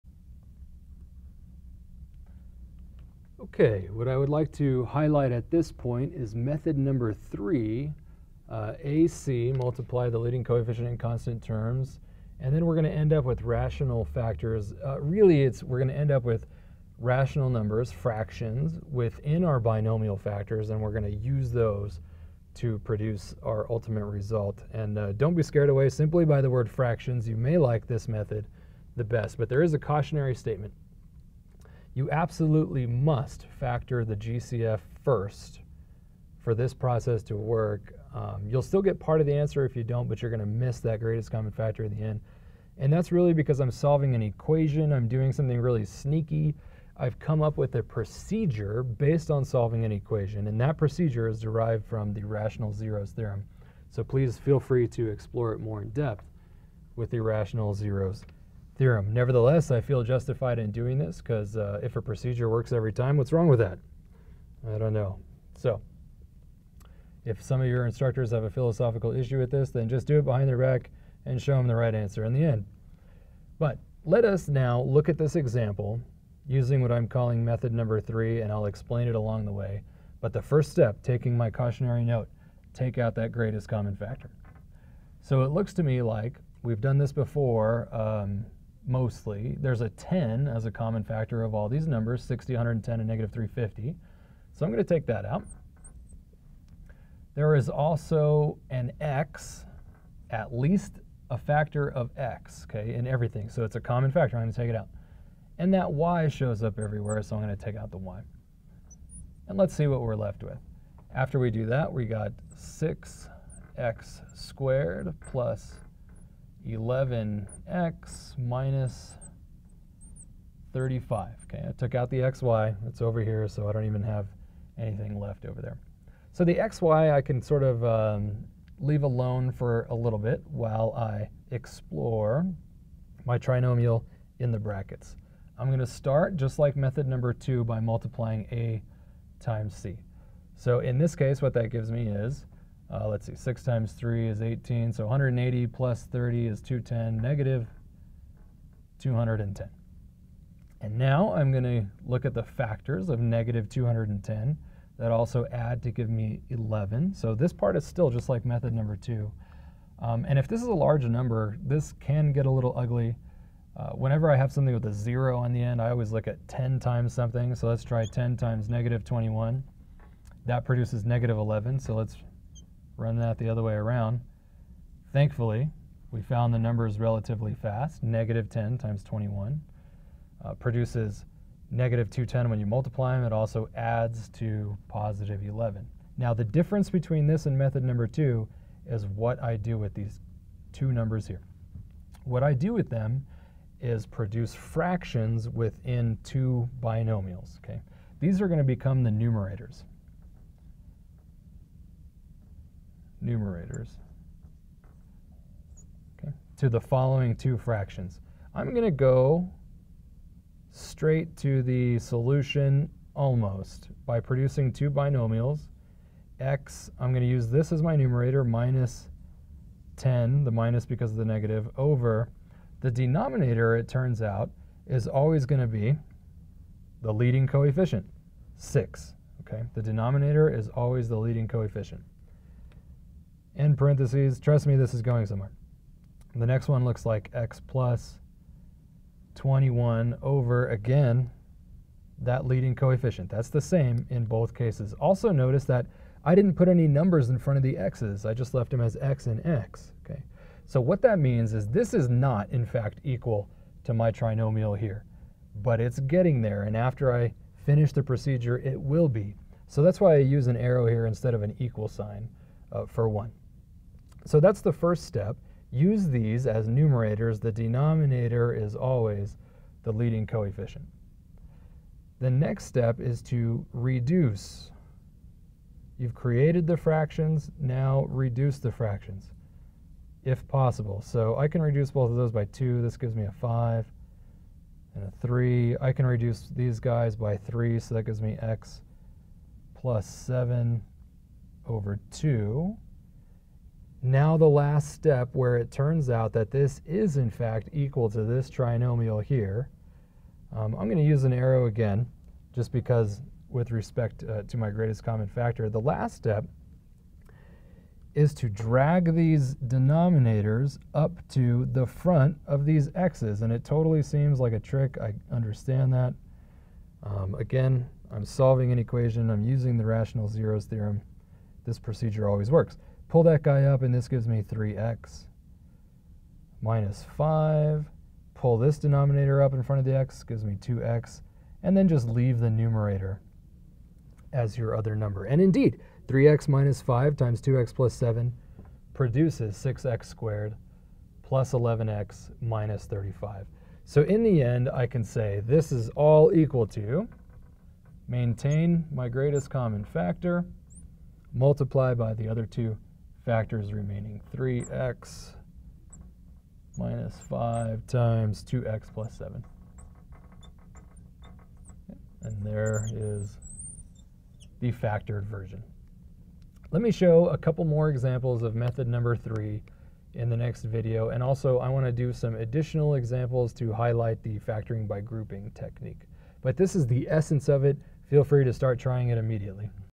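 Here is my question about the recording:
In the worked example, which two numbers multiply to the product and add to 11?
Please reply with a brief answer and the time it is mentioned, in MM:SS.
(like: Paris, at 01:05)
-10 and 21, at 02:58.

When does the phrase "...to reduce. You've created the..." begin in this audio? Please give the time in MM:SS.
04:33.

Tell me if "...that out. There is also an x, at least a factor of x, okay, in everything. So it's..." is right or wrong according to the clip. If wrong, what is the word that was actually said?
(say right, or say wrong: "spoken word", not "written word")
right.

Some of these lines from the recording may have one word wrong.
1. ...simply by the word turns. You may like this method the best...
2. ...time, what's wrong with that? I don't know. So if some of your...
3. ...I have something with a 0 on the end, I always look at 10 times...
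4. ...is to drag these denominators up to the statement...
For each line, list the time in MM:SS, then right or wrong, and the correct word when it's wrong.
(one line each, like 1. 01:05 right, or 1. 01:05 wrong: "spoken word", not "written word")
1. 00:25 wrong: "fractions", not "turns"
2. 01:02 right
3. 02:44 right
4. 05:08 wrong: "front", not "statement".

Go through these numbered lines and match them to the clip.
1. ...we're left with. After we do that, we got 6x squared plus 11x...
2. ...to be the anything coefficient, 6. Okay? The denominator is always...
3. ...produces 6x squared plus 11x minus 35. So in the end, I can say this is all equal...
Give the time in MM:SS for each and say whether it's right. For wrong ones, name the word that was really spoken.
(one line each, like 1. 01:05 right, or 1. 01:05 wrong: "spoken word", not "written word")
1. 01:50 right
2. 03:45 wrong: "leading", not "anything"
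3. 05:38 right.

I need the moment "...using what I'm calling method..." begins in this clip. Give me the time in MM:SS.
01:16.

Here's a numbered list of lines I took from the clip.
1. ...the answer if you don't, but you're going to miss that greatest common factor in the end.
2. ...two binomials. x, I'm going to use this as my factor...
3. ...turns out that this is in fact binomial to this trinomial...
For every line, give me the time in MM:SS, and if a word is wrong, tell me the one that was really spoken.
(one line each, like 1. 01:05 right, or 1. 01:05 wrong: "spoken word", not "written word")
1. 00:39 right
2. 03:34 wrong: "numerator", not "factor"
3. 04:55 wrong: "equal", not "binomial".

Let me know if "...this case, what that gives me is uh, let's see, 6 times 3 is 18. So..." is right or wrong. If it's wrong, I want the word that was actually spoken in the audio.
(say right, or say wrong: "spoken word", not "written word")
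right.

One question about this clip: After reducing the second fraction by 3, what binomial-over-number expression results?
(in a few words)
x + 7 over 2.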